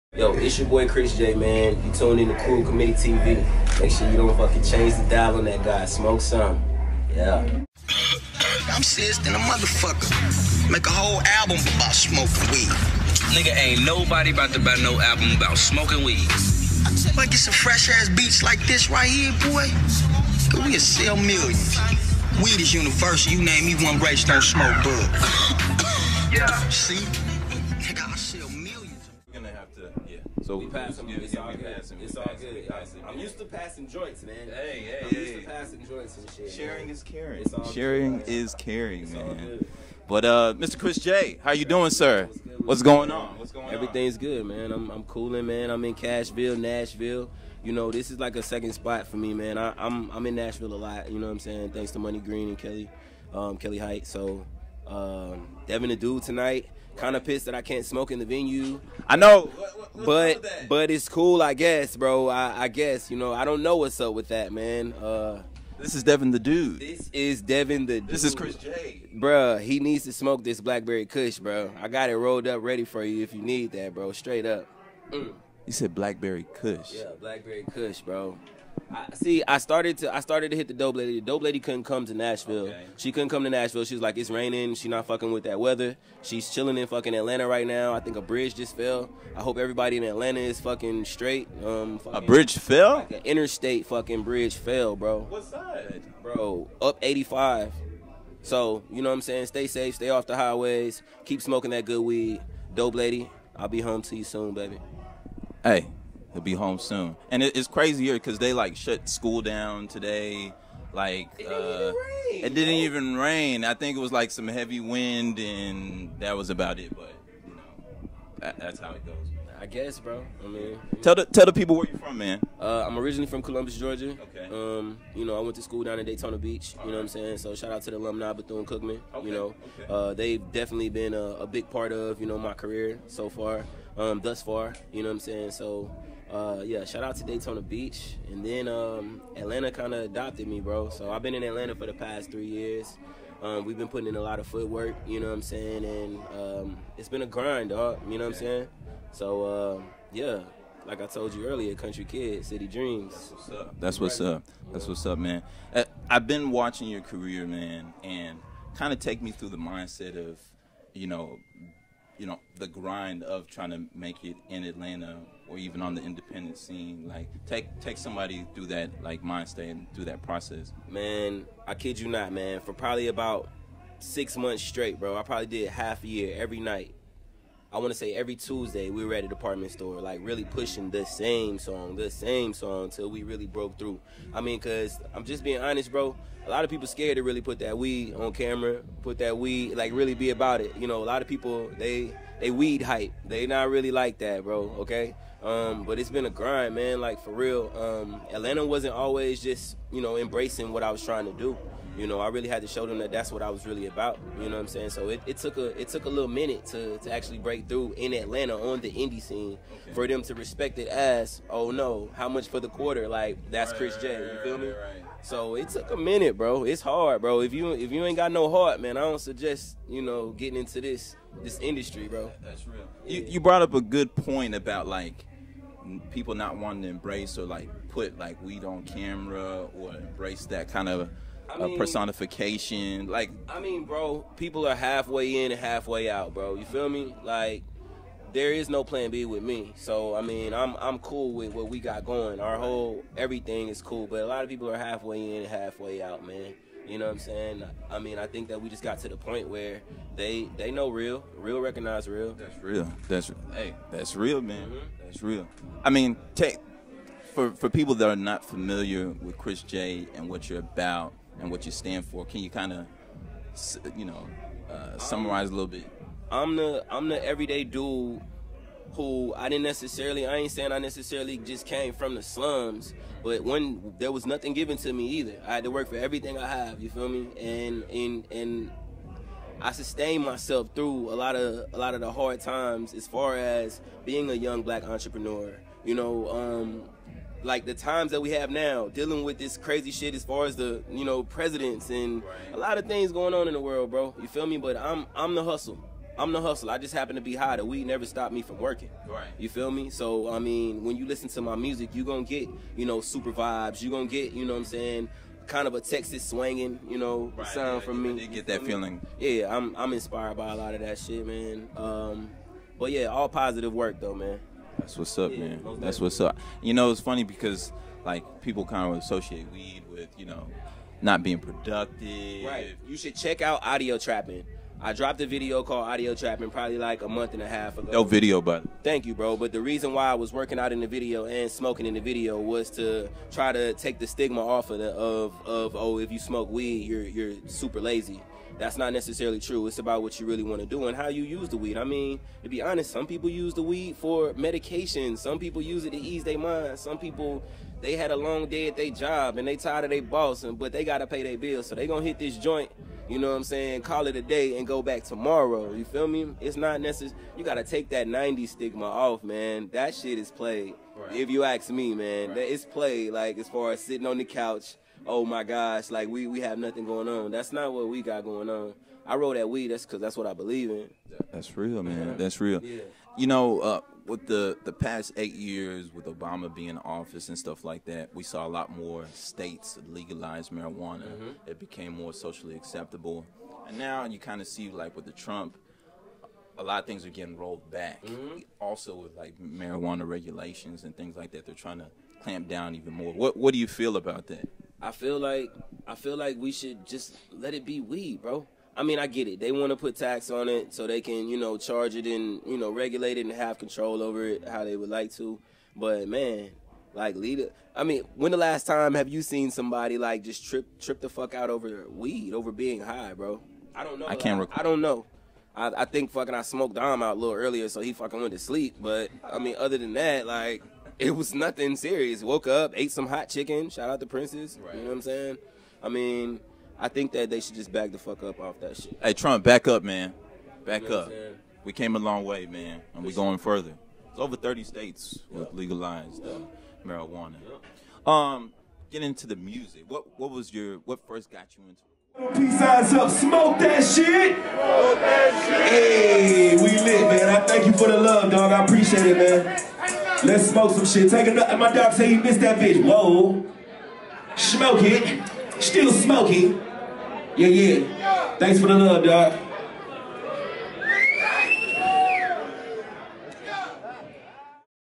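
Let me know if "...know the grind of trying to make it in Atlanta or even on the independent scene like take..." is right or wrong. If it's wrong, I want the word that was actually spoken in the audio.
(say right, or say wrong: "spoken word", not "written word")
right.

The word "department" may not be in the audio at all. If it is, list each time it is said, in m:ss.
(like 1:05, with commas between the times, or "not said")
2:59.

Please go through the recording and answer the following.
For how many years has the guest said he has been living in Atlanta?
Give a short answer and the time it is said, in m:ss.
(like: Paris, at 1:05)
3 years, at 2:22.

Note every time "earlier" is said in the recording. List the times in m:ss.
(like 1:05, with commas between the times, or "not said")
2:31, 6:57.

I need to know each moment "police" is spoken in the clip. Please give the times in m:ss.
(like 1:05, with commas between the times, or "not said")
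not said.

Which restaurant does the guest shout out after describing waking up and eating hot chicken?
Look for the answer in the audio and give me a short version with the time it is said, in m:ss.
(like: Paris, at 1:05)
Prince's, at 7:04.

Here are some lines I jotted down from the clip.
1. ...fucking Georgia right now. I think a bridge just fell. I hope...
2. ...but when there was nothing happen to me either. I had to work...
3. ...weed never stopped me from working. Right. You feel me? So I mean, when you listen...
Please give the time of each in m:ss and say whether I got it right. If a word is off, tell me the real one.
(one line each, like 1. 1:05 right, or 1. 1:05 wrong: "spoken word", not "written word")
1. 1:26 wrong: "Atlanta", not "Georgia"
2. 4:33 wrong: "given", not "happen"
3. 4:57 right.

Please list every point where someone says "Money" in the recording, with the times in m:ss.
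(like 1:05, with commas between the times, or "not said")
0:51.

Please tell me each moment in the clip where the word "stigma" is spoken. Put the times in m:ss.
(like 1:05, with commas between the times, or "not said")
5:34, 5:58.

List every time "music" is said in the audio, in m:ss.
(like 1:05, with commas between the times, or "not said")
5:01, 7:19.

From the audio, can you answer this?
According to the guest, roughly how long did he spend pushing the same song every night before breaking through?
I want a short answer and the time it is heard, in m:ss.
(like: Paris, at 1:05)
6 months, at 2:53.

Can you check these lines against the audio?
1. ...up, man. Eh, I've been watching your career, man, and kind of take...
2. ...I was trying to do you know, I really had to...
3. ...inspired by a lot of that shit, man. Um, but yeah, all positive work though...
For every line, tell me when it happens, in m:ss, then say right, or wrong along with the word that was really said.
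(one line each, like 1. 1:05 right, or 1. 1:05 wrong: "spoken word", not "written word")
1. 2:35 right
2. 3:20 right
3. 5:09 right.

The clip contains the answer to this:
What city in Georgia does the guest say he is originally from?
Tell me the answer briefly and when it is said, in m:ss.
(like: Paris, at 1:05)
Columbus, at 2:03.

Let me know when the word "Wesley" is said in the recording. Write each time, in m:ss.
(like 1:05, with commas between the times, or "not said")
not said.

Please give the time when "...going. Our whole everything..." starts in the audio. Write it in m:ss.
4:02.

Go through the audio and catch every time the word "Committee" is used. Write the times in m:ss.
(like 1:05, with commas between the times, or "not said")
0:02.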